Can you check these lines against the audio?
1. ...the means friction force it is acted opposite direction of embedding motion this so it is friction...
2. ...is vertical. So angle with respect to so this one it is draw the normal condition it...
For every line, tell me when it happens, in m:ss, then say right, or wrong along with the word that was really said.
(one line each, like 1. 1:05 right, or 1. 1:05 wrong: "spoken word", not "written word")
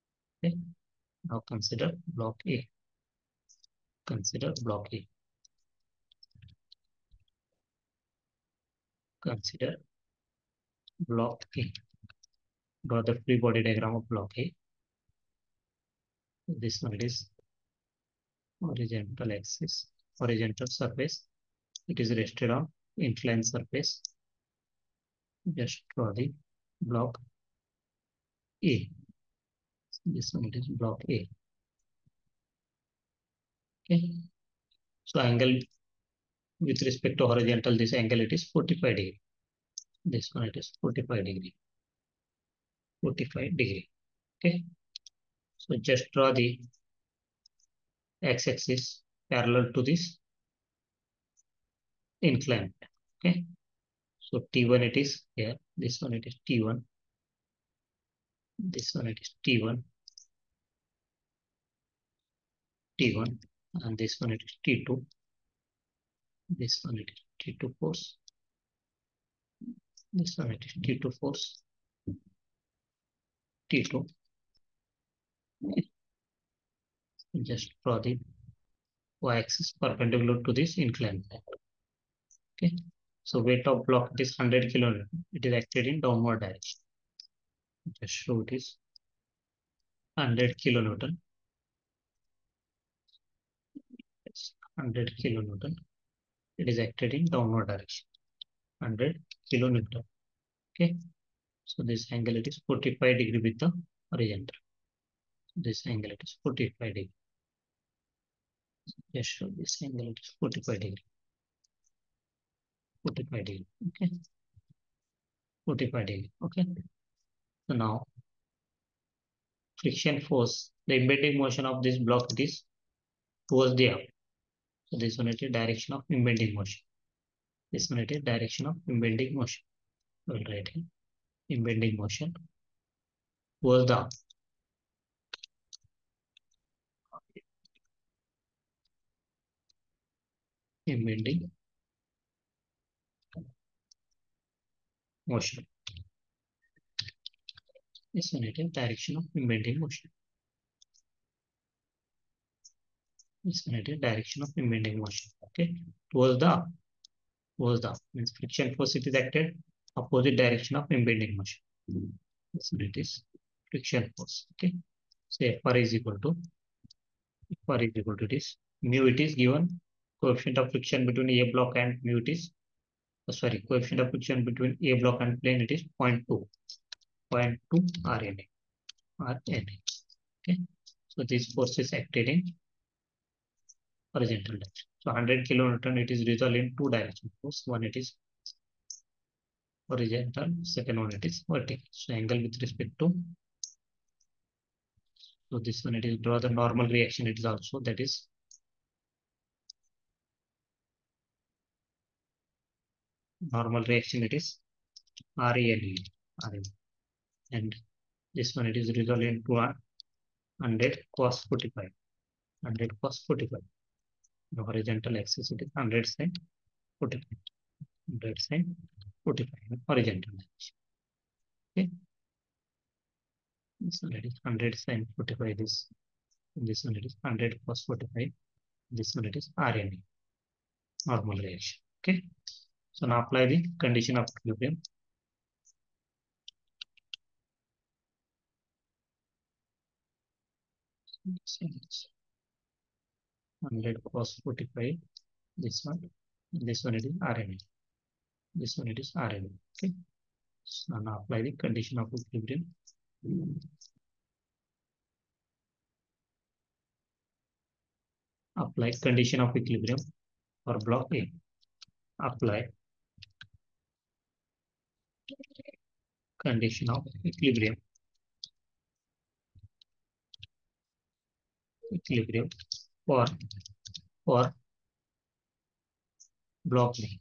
1. 2:37 right
2. 3:11 wrong: "reaction", not "condition".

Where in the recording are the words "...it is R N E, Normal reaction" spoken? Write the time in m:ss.
3:49.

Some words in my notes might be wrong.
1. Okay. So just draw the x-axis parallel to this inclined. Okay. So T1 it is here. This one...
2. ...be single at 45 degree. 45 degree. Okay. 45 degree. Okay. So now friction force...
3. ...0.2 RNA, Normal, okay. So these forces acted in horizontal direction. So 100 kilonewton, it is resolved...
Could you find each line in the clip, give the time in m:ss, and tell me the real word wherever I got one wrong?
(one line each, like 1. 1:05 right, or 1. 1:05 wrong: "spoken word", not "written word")
1. 0:44 right
2. 1:49 right
3. 2:57 wrong: "RNA", not "Normal".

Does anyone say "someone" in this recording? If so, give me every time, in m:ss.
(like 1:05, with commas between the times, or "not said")
not said.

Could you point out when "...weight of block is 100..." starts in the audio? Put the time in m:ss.
1:23.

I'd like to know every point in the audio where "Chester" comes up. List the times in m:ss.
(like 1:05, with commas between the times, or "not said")
not said.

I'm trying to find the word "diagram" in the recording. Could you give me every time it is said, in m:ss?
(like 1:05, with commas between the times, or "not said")
0:13.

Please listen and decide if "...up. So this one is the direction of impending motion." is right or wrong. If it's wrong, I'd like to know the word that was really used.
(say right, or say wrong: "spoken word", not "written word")
right.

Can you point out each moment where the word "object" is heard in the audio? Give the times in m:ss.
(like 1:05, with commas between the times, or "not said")
not said.